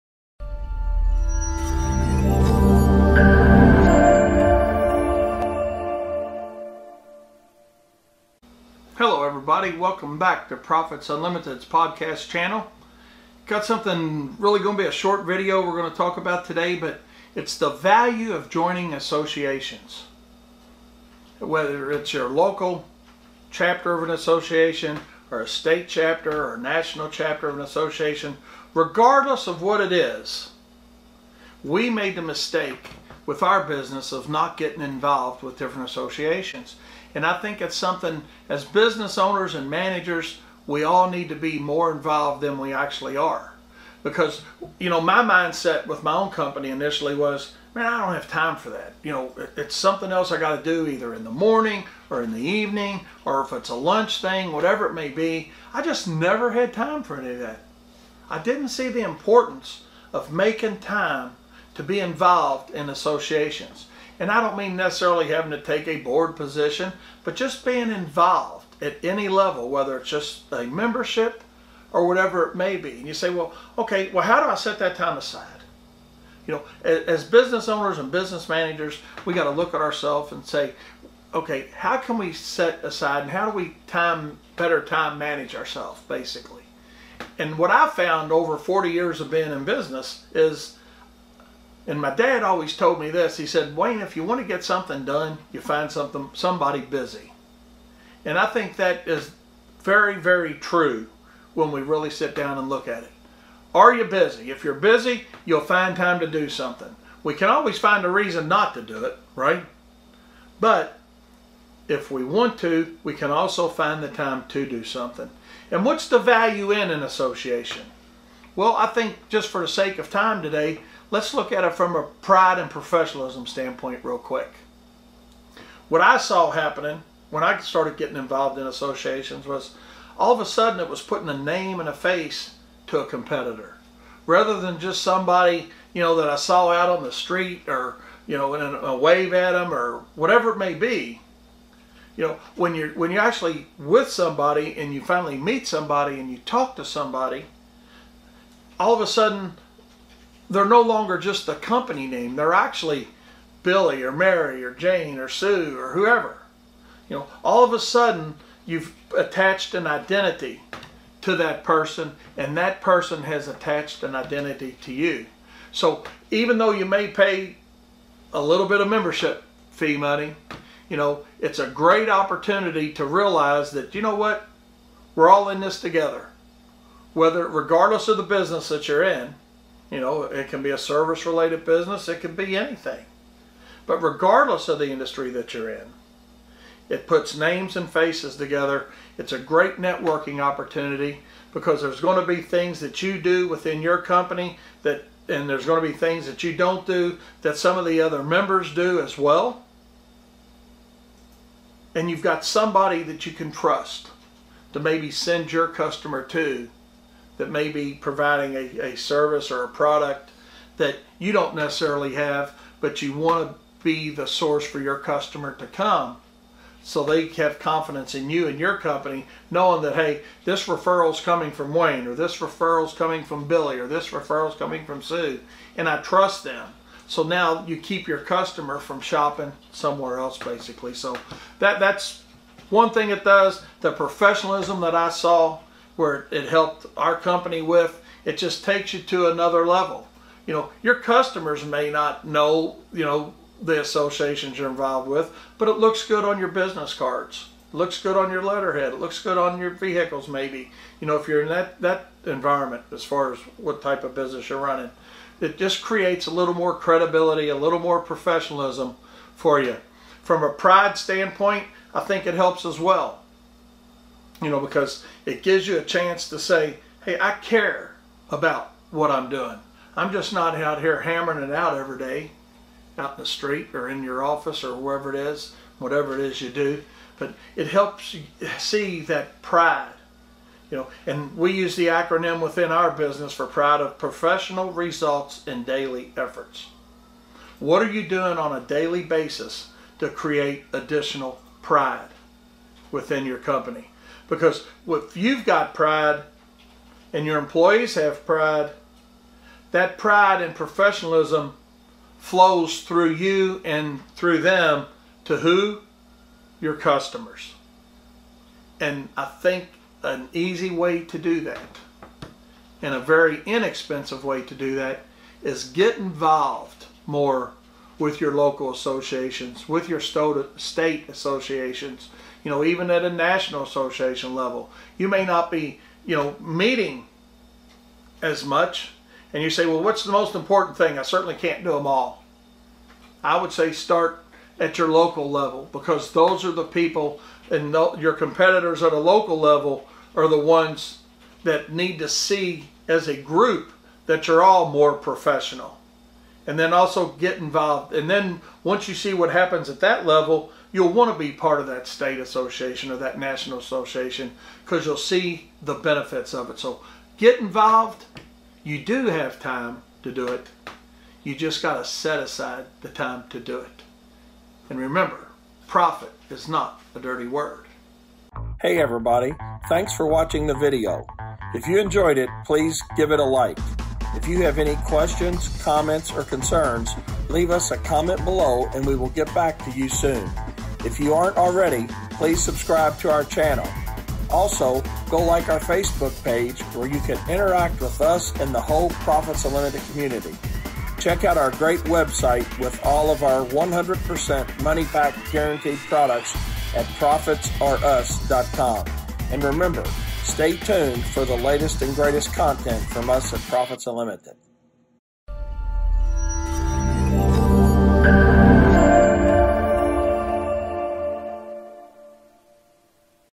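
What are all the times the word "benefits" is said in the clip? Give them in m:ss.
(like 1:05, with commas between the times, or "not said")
5:55.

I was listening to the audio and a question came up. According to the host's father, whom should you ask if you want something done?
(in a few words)
somebody busy.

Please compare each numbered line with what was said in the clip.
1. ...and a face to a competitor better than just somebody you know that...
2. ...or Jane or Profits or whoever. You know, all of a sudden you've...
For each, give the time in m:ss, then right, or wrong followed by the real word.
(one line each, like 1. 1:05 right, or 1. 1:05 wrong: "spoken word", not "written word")
1. 2:11 wrong: "rather", not "better"
2. 2:34 wrong: "Sue", not "Profits".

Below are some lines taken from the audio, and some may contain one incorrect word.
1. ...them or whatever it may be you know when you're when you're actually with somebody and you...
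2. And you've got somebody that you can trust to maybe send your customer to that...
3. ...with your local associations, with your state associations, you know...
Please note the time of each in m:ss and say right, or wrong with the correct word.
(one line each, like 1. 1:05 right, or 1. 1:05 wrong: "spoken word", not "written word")
1. 2:19 right
2. 3:21 right
3. 5:18 right.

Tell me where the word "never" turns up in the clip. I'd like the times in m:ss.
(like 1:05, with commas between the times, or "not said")
0:56.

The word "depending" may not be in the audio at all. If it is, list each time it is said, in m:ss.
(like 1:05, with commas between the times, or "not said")
not said.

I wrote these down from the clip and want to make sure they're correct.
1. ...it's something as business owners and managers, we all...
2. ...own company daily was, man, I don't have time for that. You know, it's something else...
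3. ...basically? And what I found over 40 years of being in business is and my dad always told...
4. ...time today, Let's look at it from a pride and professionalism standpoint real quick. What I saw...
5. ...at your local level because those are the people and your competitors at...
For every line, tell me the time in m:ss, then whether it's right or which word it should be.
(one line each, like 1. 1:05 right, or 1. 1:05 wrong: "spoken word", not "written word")
1. 0:37 right
2. 0:46 wrong: "initially", not "daily"
3. 1:26 right
4. 2:00 right
5. 5:34 right.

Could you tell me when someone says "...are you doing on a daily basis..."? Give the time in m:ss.
4:47.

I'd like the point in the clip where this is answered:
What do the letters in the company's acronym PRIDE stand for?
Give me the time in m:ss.
4:43.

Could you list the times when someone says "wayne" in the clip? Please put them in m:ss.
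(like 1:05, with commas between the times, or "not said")
1:33, 3:41.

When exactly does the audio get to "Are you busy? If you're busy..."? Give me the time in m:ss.
1:43.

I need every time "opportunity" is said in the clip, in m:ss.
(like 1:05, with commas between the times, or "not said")
2:52, 3:10.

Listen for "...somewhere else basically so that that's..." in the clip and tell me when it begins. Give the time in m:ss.
3:49.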